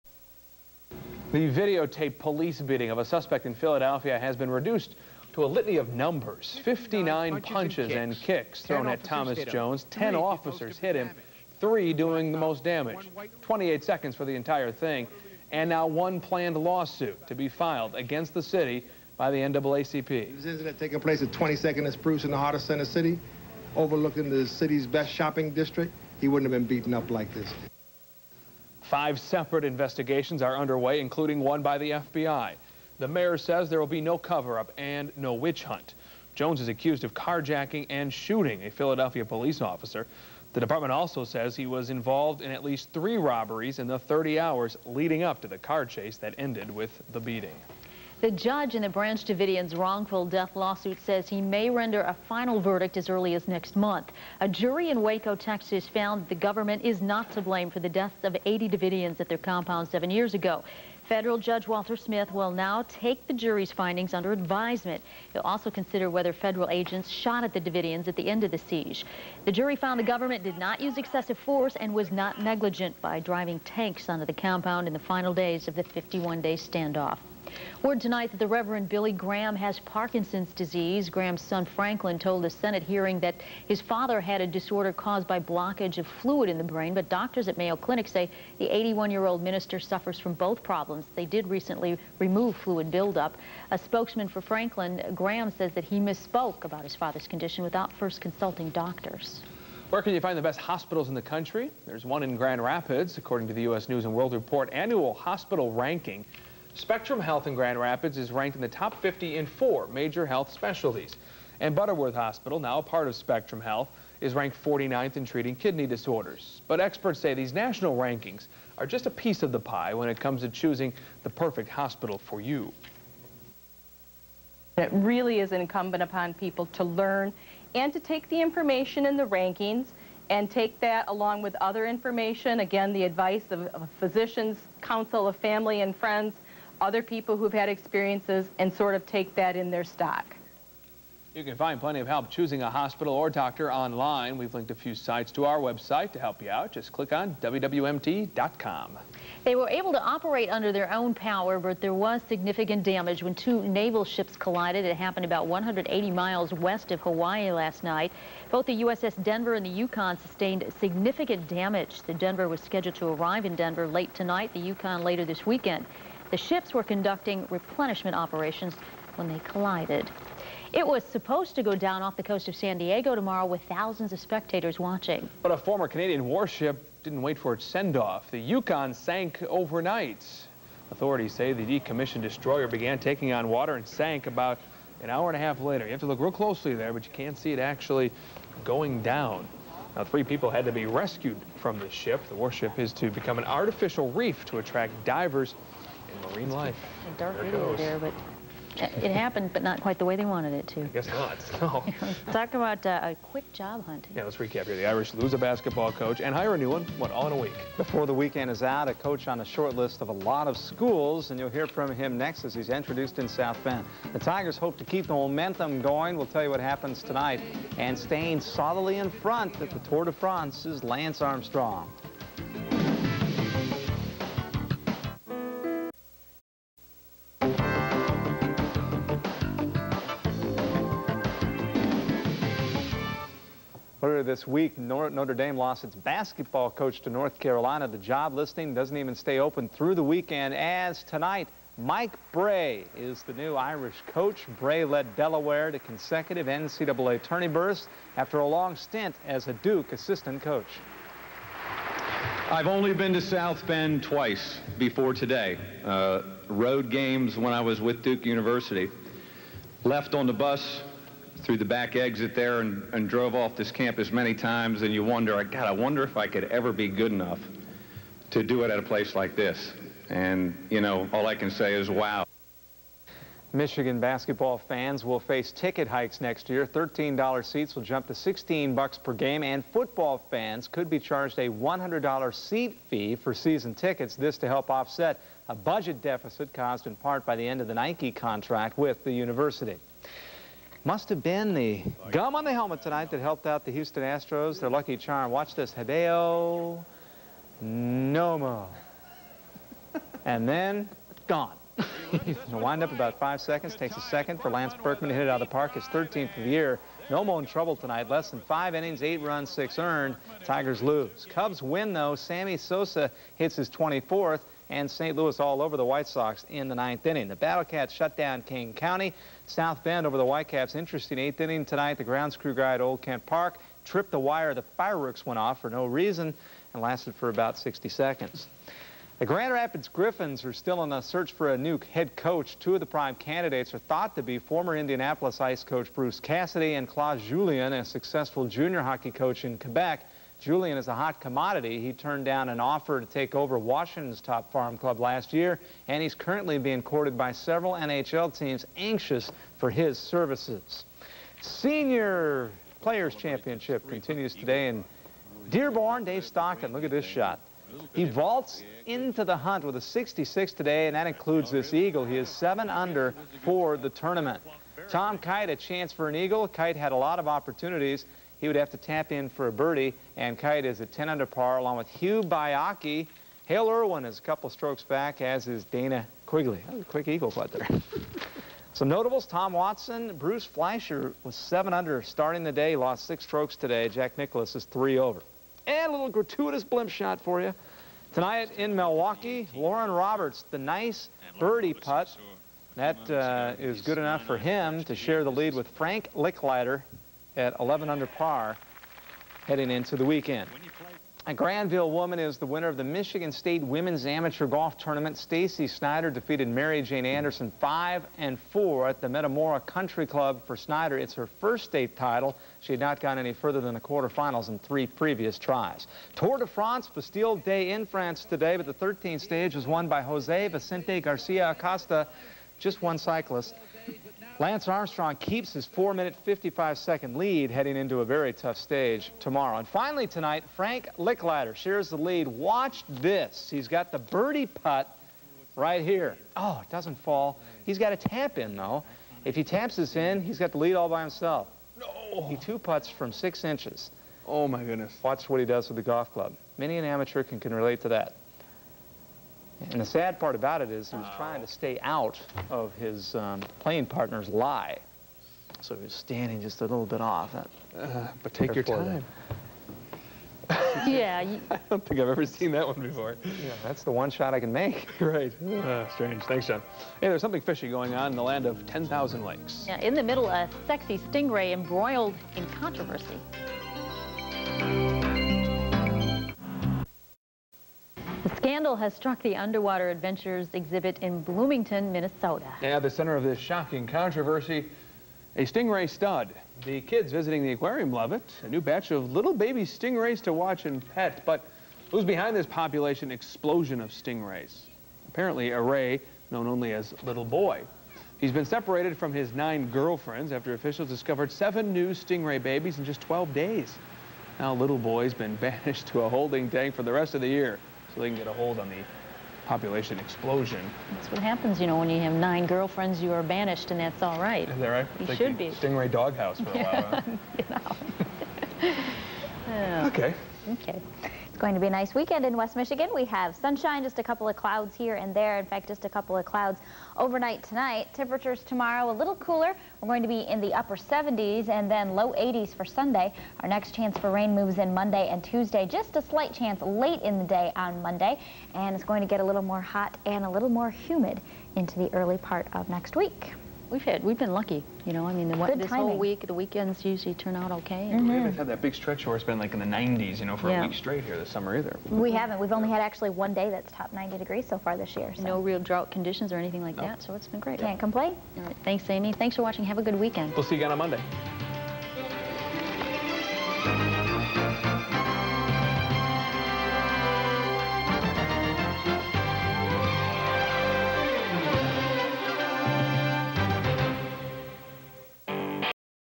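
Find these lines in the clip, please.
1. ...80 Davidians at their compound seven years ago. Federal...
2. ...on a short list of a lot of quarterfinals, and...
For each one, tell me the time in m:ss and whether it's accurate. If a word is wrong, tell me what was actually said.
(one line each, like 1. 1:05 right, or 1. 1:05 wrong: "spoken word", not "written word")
1. 0:58 right
2. 3:29 wrong: "schools", not "quarterfinals".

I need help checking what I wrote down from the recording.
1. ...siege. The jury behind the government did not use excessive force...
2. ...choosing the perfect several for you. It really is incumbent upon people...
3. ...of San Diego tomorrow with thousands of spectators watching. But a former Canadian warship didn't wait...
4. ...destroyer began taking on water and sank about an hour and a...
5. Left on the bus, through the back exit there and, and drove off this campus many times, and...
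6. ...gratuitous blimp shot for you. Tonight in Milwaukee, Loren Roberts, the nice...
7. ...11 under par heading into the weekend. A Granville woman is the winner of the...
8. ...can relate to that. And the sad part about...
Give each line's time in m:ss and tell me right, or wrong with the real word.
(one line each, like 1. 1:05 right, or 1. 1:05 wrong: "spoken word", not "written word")
1. 1:08 wrong: "found", not "behind"
2. 2:00 wrong: "hospital", not "several"
3. 2:52 right
4. 3:02 right
5. 4:19 right
6. 6:26 right
7. 6:37 right
8. 7:27 right.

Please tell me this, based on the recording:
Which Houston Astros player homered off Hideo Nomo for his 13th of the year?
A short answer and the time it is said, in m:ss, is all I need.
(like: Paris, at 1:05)
Lance Berkman, at 5:04.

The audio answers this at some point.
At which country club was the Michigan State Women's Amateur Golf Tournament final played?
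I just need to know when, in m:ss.
6:49.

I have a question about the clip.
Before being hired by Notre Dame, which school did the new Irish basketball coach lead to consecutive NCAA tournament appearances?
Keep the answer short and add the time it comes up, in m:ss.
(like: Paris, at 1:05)
Delaware, at 4:05.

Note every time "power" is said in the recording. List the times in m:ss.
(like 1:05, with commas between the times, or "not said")
2:31.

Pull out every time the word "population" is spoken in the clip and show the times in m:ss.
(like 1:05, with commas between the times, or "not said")
8:12, 8:29.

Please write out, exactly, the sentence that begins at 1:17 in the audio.
Word tonight that the Reverend Billy Graham has Parkinson's disease.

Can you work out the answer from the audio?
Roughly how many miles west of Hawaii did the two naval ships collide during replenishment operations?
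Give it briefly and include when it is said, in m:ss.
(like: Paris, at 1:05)
180 miles, at 2:35.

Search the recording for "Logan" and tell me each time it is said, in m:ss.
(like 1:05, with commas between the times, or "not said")
not said.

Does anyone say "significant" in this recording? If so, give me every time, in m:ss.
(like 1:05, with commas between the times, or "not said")
2:32, 2:40.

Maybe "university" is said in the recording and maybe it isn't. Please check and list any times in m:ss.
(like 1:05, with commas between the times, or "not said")
4:18, 4:49.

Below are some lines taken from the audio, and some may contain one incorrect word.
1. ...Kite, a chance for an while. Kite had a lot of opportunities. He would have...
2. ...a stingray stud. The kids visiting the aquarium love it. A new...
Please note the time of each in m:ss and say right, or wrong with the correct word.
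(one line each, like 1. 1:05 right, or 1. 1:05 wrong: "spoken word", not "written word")
1. 6:05 wrong: "eagle", not "while"
2. 8:05 right.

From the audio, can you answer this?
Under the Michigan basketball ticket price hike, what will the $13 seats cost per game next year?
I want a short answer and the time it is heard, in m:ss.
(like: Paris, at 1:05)
$16, at 4:38.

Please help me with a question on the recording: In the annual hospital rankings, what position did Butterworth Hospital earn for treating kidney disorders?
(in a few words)
49th.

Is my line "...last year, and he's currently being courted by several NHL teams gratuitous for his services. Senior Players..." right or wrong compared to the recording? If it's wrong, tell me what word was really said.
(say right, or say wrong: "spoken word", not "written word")
wrong: "anxious", not "gratuitous".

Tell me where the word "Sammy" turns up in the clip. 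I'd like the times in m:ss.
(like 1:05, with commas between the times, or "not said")
5:12.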